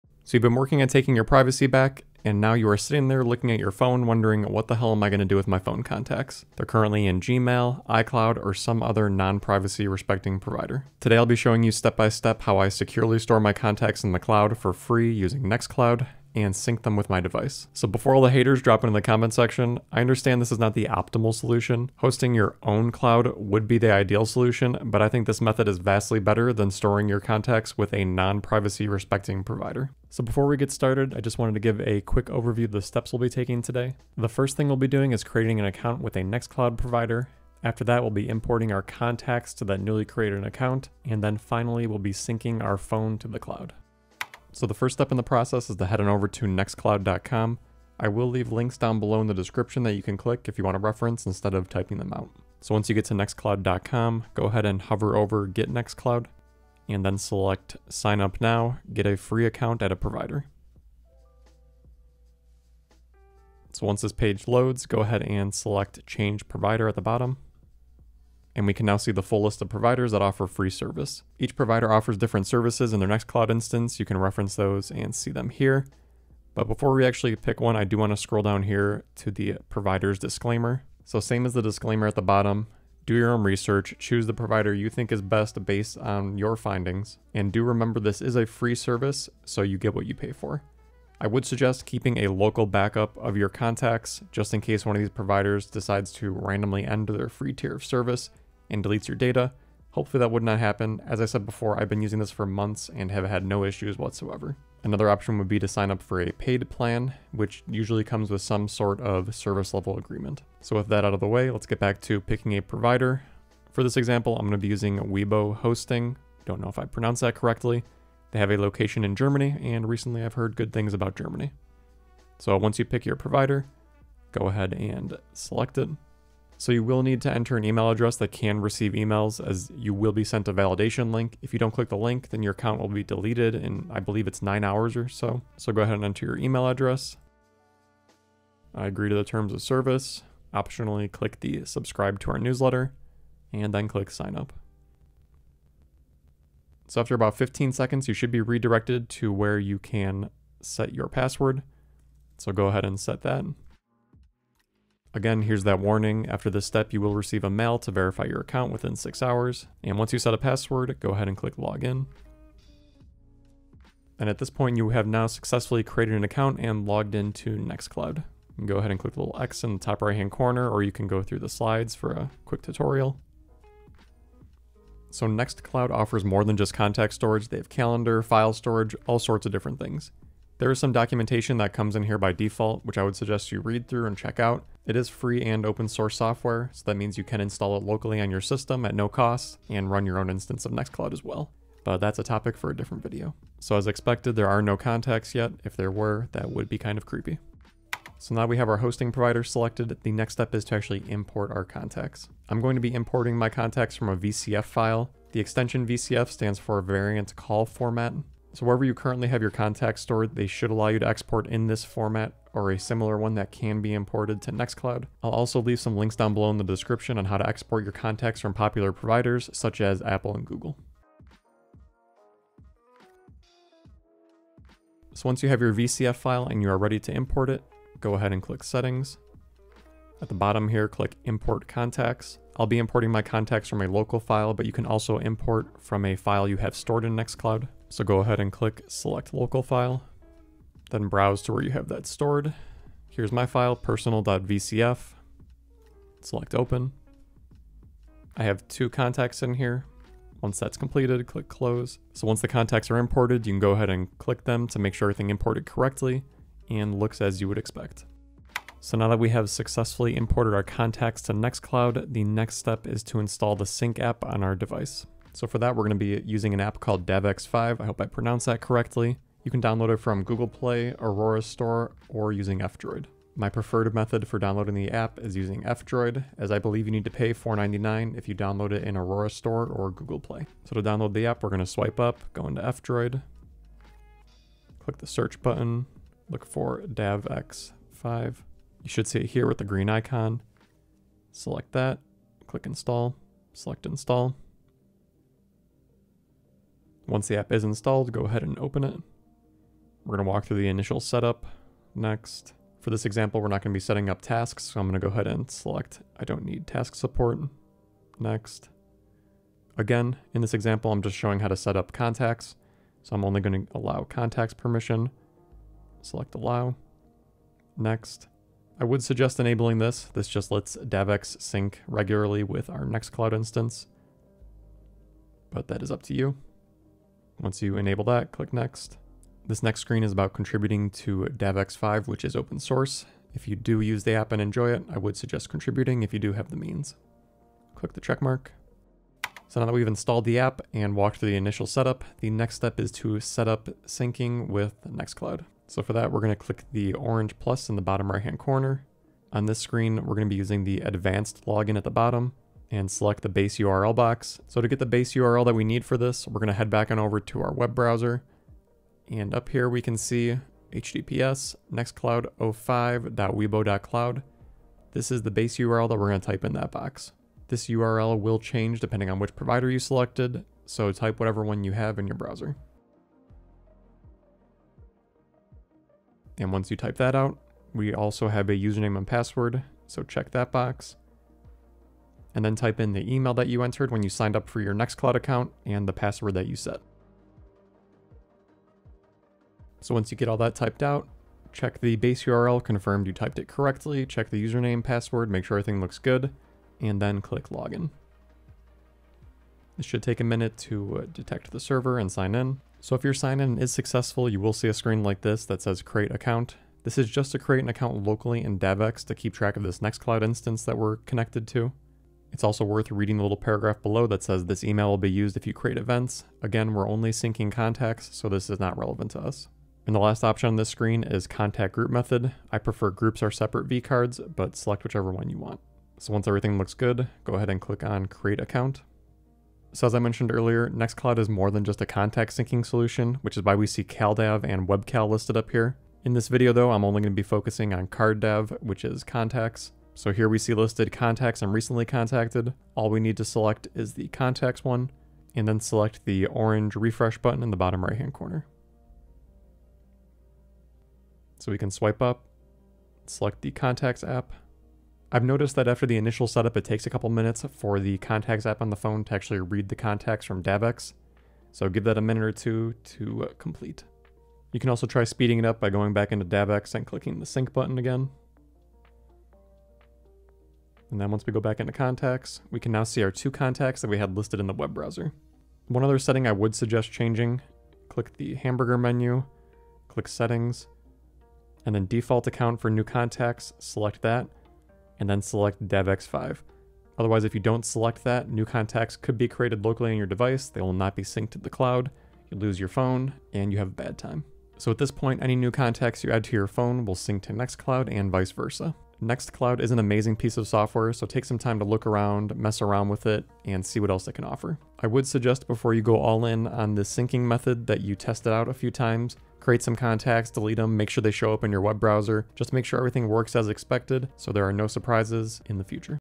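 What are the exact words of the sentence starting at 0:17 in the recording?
So before all the haters drop into the comment section, I understand this is not the optimal solution.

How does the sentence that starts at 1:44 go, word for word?
Another option would be to sign up for a paid plan, which usually comes with some sort of service level agreement.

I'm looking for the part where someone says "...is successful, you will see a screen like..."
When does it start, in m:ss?
6:43.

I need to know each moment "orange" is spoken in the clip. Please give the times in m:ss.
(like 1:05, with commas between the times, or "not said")
5:46, 7:26.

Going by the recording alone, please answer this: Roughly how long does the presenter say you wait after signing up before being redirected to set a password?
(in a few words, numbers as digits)
15 seconds.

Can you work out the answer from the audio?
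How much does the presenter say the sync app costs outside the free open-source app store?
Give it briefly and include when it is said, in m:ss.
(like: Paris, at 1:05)
$4.99, at 4:37.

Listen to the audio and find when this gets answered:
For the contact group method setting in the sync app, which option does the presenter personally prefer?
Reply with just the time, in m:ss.
7:02.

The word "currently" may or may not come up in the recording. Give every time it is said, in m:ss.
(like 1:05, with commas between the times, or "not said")
0:06, 3:28.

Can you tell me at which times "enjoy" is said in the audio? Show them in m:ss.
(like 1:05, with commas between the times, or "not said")
5:34.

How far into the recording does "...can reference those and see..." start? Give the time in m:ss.
1:14.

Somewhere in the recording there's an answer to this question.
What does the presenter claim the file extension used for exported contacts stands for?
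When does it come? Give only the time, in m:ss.
3:26.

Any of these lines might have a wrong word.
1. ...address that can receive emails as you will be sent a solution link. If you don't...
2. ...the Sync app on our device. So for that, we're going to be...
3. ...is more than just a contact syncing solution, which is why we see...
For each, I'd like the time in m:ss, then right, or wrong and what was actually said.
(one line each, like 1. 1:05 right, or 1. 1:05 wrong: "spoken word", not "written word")
1. 2:07 wrong: "validation", not "solution"
2. 4:23 right
3. 7:11 right.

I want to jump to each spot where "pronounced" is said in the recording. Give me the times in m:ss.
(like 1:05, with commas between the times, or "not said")
1:56, 4:28.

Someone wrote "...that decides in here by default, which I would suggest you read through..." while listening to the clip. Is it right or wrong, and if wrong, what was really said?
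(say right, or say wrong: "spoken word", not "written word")
wrong: "comes", not "decides".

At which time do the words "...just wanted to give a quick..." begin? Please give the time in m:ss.
0:31.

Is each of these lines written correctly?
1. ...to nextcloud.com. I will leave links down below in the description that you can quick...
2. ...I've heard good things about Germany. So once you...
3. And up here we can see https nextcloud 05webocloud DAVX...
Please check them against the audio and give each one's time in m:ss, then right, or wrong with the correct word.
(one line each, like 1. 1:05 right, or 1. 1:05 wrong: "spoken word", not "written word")
1. 0:46 wrong: "click", not "quick"
2. 2:00 right
3. 5:59 wrong: "This", not "DAVX".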